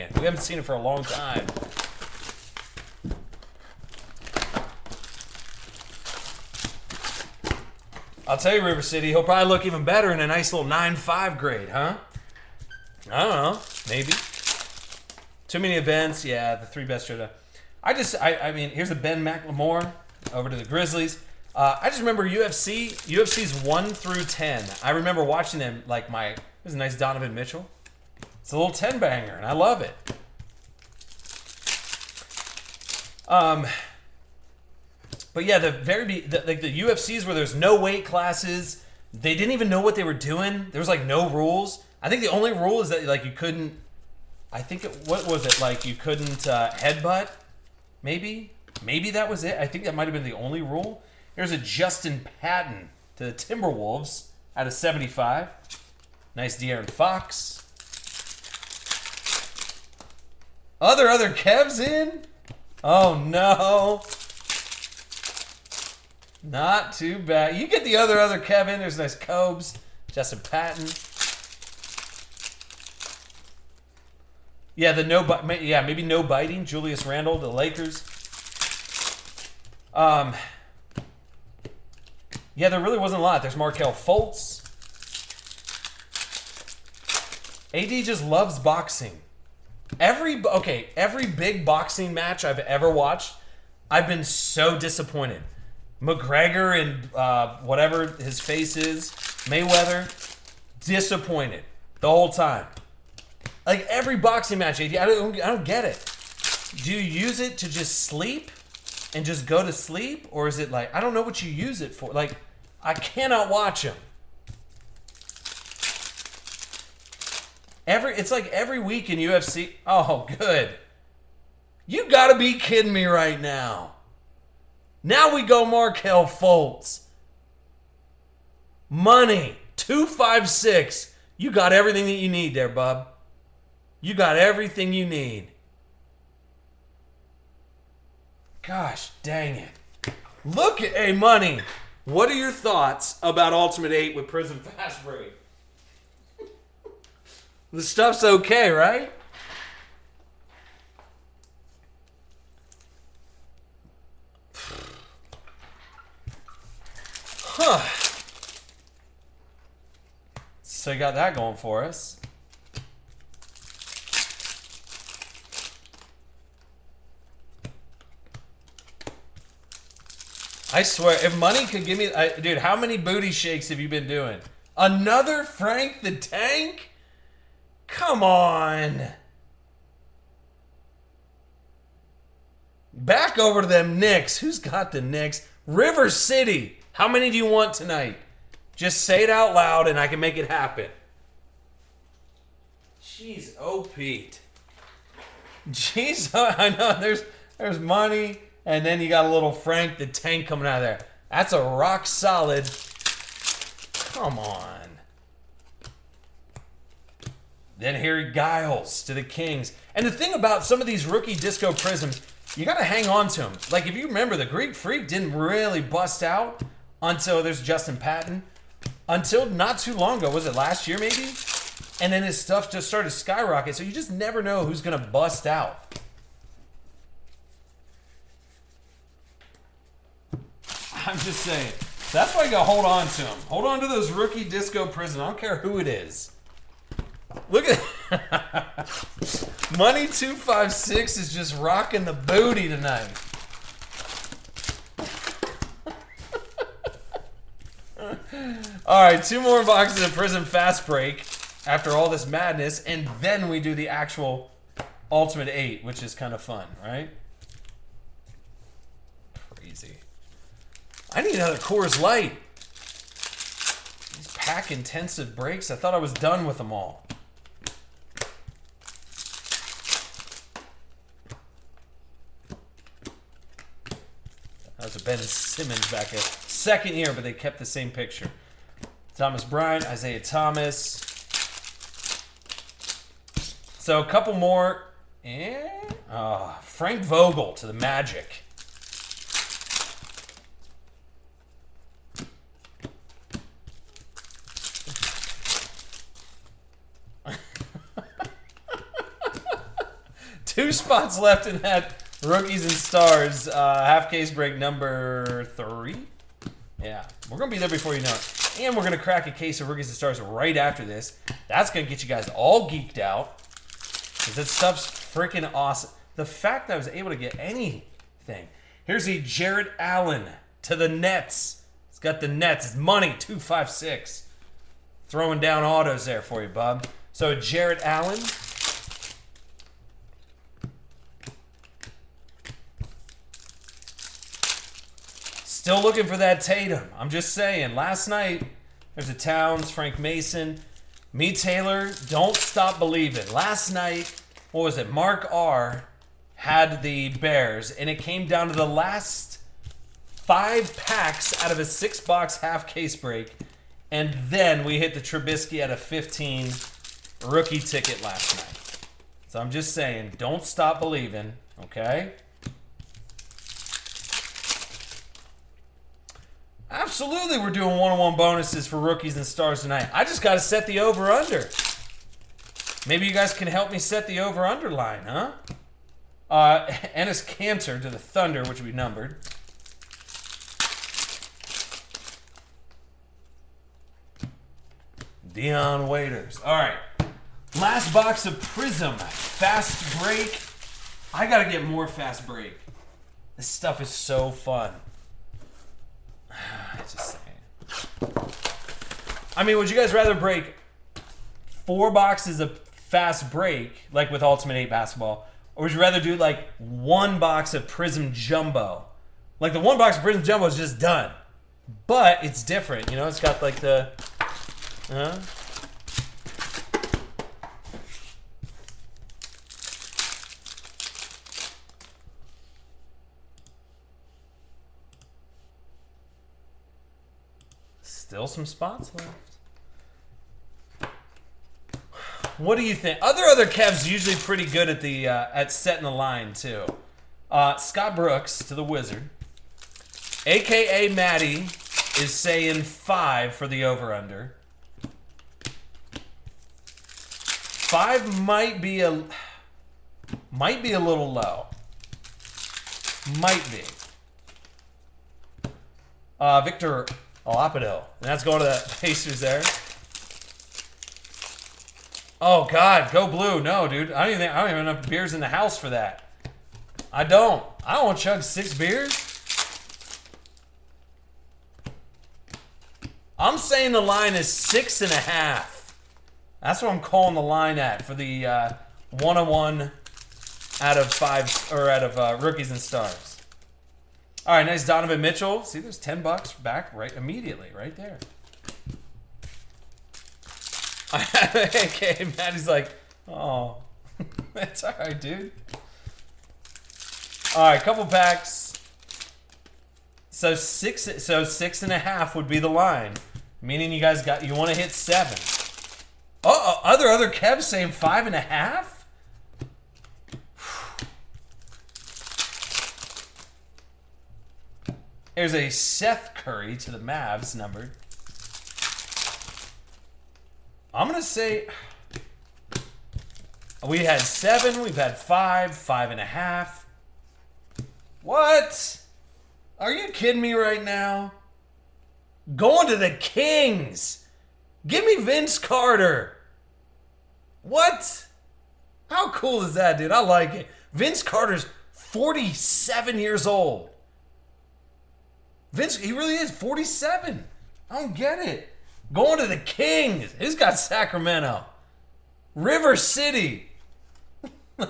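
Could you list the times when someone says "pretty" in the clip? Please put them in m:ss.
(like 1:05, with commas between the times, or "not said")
7:14.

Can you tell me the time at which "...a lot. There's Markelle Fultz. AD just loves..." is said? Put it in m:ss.
1:23.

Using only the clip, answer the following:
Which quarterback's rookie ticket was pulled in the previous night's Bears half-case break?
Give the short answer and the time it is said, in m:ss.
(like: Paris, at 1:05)
Trubisky, at 5:54.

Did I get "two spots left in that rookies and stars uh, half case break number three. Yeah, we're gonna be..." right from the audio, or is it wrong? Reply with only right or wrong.
right.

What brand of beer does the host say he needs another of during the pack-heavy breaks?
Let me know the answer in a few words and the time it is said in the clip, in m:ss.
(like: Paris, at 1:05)
Coors Light, at 4:21.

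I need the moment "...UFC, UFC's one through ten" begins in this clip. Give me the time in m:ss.
0:22.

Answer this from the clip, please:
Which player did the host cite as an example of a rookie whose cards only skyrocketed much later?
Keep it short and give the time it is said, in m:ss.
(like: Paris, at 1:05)
the Greek Freak, at 3:34.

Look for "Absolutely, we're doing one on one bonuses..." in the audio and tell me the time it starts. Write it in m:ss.
6:06.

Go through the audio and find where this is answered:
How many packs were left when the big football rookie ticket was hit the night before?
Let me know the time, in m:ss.
5:48.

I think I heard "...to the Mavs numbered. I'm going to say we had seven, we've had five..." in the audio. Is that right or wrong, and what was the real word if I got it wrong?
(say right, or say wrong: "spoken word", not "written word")
right.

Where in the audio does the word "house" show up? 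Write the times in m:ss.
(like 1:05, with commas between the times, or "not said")
7:45.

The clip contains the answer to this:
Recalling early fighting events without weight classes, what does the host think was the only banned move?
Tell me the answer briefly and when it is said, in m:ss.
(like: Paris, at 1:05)
headbutt, at 0:46.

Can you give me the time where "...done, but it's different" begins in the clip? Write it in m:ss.
6:50.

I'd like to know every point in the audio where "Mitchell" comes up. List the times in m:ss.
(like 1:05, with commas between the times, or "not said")
0:27, 8:04.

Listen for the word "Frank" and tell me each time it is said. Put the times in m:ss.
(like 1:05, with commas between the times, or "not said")
2:55, 3:19, 4:46, 5:39.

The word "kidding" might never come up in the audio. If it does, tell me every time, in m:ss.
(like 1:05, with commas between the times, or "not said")
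2:02, 8:49.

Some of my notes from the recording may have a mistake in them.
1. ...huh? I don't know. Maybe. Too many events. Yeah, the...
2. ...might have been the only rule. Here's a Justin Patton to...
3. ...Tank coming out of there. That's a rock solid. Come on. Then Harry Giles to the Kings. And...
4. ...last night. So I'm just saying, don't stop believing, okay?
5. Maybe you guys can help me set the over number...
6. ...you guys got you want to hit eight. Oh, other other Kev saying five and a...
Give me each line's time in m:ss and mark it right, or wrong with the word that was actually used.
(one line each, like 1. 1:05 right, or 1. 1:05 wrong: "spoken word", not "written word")
1. 0:11 right
2. 0:49 right
3. 3:20 right
4. 5:58 right
5. 6:12 wrong: "under", not "number"
6. 8:23 wrong: "seven", not "eight".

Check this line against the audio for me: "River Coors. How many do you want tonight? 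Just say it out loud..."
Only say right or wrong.
wrong.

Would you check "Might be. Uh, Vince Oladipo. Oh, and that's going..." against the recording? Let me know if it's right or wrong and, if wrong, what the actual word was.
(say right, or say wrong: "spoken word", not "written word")
wrong: "Victor", not "Vince".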